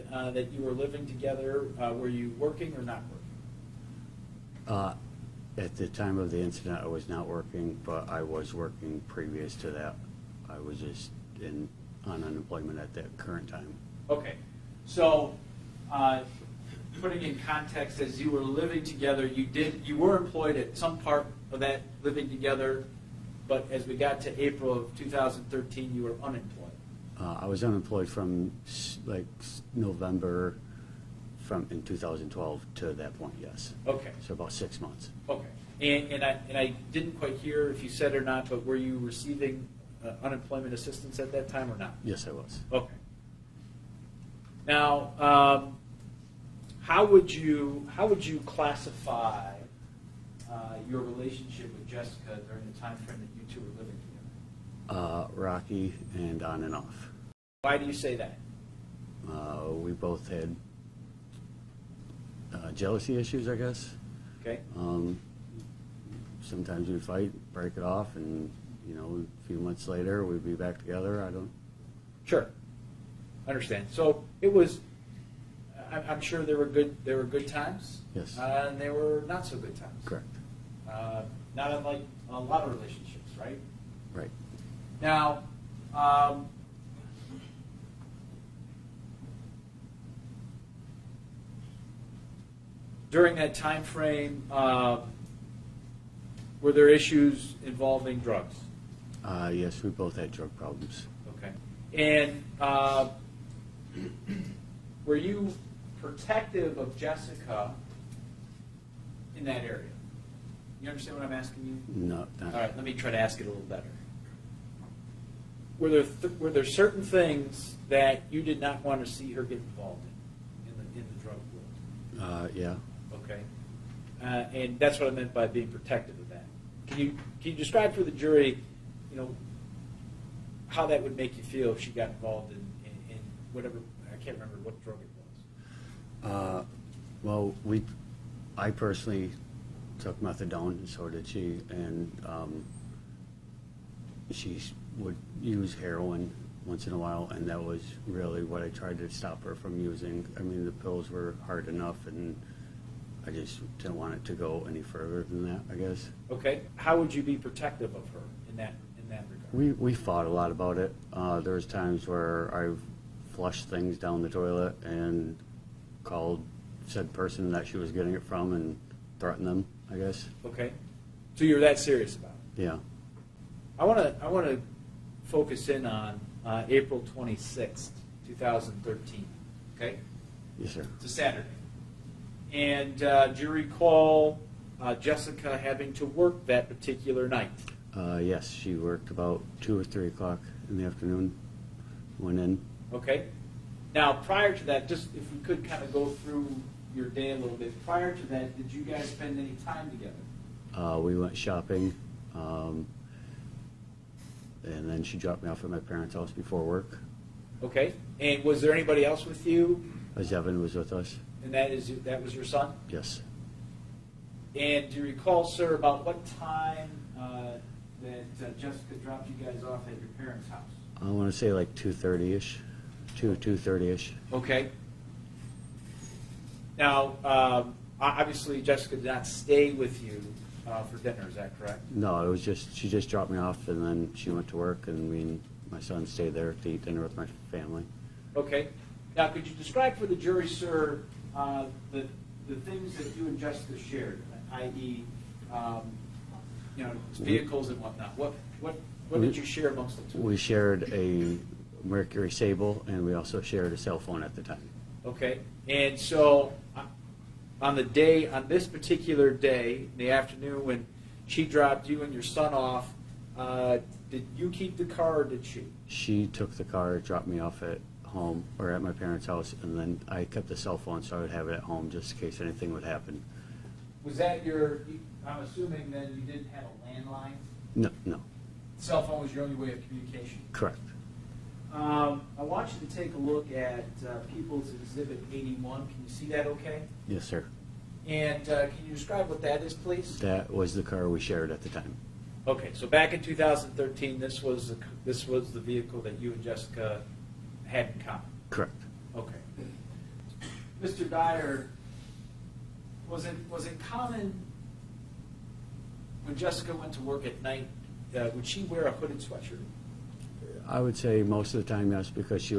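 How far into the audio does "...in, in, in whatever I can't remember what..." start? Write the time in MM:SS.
02:12.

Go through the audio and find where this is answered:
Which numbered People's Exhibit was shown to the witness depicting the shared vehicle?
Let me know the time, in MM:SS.
04:45.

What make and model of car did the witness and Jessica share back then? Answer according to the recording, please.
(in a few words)
Mercury Sable.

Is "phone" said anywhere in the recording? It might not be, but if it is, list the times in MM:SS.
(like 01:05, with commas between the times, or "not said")
04:13, 04:30, 04:39.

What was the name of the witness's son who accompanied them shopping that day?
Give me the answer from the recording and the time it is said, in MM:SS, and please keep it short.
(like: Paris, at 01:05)
Zevyn, at 03:30.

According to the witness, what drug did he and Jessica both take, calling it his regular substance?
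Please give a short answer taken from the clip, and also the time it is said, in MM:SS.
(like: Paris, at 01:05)
methadone, at 02:20.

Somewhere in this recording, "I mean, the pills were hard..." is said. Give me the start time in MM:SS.
02:30.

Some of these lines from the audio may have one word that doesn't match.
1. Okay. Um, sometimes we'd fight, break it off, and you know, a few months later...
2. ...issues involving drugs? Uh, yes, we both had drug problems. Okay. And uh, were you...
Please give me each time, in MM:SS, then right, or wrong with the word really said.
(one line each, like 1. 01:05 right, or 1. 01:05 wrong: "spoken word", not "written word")
1. 01:04 right
2. 01:36 right.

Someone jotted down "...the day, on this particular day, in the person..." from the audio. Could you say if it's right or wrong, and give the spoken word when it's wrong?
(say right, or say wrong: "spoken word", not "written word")
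wrong: "afternoon", not "person".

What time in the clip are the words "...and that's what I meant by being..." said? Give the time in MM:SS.
02:04.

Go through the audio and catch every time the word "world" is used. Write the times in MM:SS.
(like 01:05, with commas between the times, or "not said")
02:02.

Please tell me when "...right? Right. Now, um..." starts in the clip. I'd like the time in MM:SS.
01:23.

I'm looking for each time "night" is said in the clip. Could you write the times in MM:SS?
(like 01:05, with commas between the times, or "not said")
03:07, 05:07.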